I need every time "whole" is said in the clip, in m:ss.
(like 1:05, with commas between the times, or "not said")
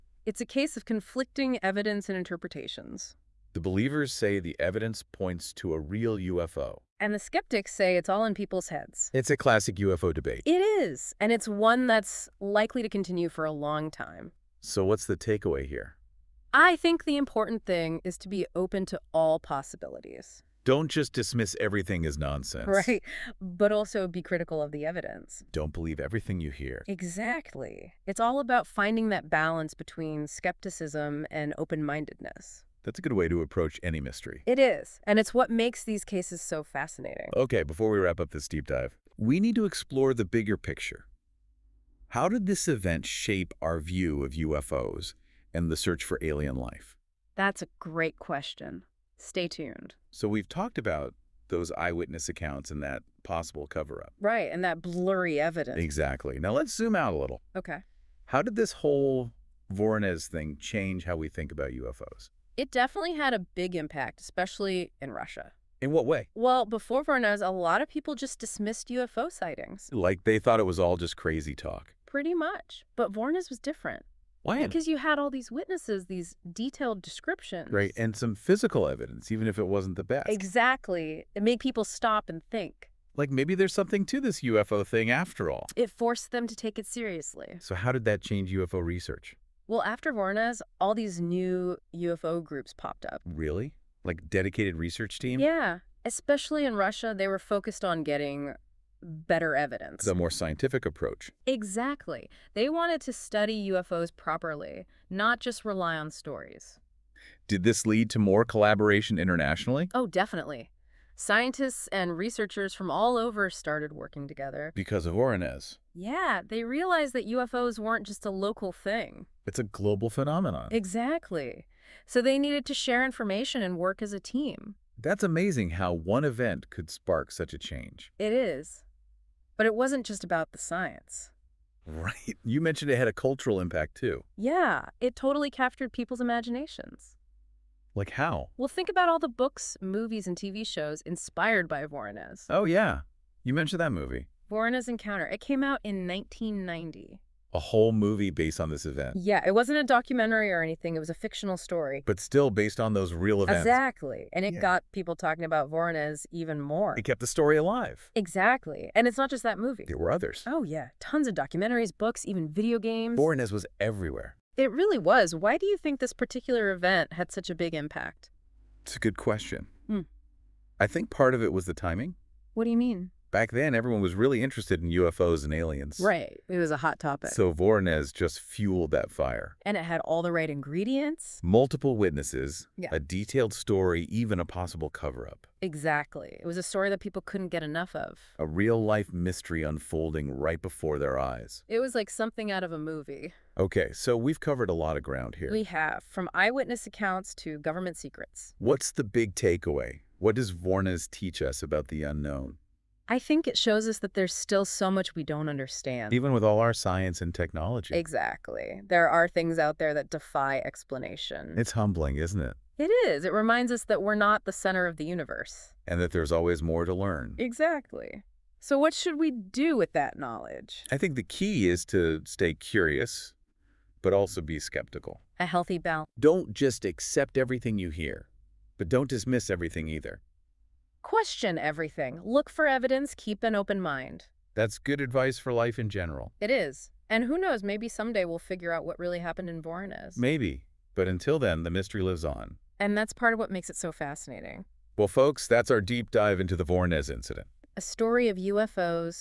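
0:58, 2:27.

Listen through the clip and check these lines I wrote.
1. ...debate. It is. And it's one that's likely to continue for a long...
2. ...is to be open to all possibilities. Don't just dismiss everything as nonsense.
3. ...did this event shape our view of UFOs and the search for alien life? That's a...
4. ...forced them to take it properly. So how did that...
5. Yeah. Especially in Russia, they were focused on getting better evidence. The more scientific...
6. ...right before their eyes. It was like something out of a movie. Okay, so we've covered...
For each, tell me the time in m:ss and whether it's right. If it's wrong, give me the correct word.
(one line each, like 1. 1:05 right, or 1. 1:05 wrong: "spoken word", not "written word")
1. 0:10 right
2. 0:18 right
3. 0:42 right
4. 1:25 wrong: "seriously", not "properly"
5. 1:35 right
6. 3:10 right.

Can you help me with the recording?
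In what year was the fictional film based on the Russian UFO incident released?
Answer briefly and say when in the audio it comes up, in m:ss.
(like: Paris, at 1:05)
1990, at 2:25.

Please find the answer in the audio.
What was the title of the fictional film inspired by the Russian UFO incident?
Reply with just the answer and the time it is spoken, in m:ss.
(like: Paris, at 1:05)
Voronezh Encounter, at 2:24.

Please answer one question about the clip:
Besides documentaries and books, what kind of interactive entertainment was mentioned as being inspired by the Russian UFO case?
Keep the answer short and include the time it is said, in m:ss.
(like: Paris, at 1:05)
Video games, at 2:42.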